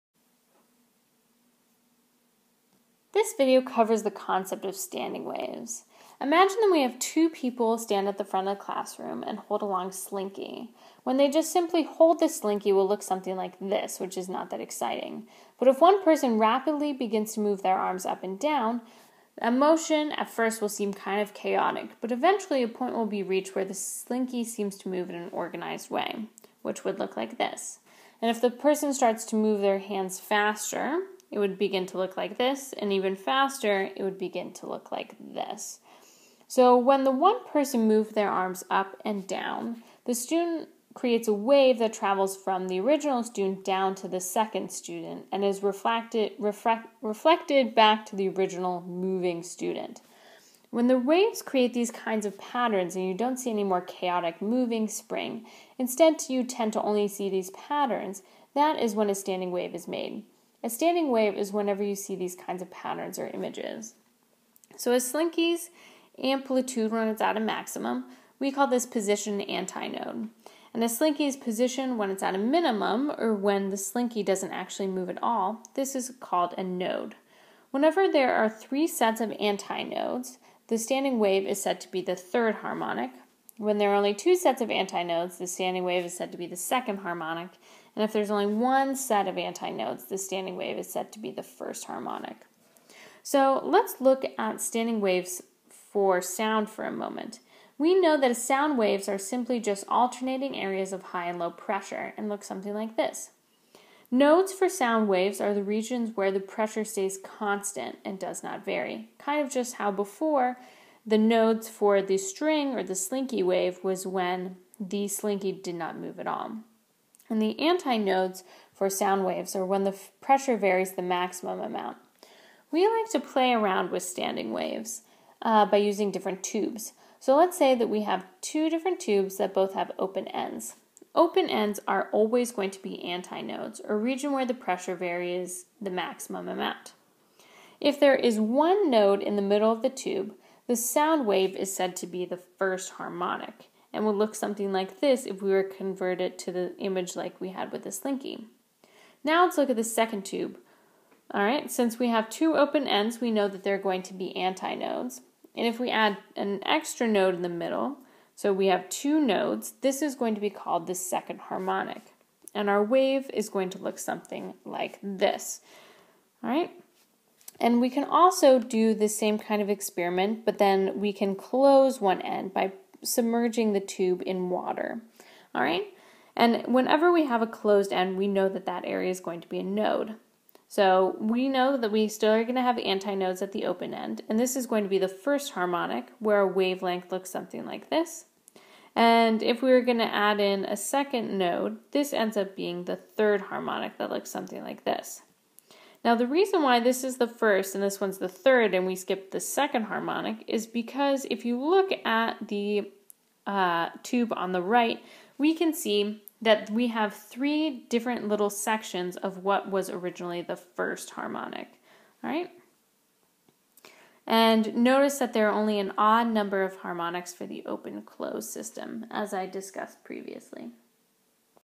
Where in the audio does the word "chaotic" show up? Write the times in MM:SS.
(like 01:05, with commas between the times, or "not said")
00:21, 00:53.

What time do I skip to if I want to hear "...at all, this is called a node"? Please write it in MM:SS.
01:15.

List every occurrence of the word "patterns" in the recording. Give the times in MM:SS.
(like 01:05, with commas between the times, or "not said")
00:52, 00:57, 01:02.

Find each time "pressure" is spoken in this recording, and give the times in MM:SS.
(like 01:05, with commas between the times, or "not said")
01:41, 01:46, 02:00, 02:14.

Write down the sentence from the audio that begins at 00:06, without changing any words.
Imagine that we have two people stand at the front of the classroom and hold a long slinky.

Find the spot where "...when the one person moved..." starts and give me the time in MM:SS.
00:36.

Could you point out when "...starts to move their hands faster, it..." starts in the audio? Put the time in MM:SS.
00:28.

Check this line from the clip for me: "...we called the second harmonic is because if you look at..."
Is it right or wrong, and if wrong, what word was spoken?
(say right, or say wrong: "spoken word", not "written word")
wrong: "skipped", not "called".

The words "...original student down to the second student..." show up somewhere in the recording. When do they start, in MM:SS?
00:42.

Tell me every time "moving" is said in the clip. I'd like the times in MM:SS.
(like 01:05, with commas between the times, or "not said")
00:48, 00:54.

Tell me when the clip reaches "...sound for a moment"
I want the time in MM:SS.
01:36.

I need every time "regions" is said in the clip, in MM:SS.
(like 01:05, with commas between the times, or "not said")
01:45, 02:13.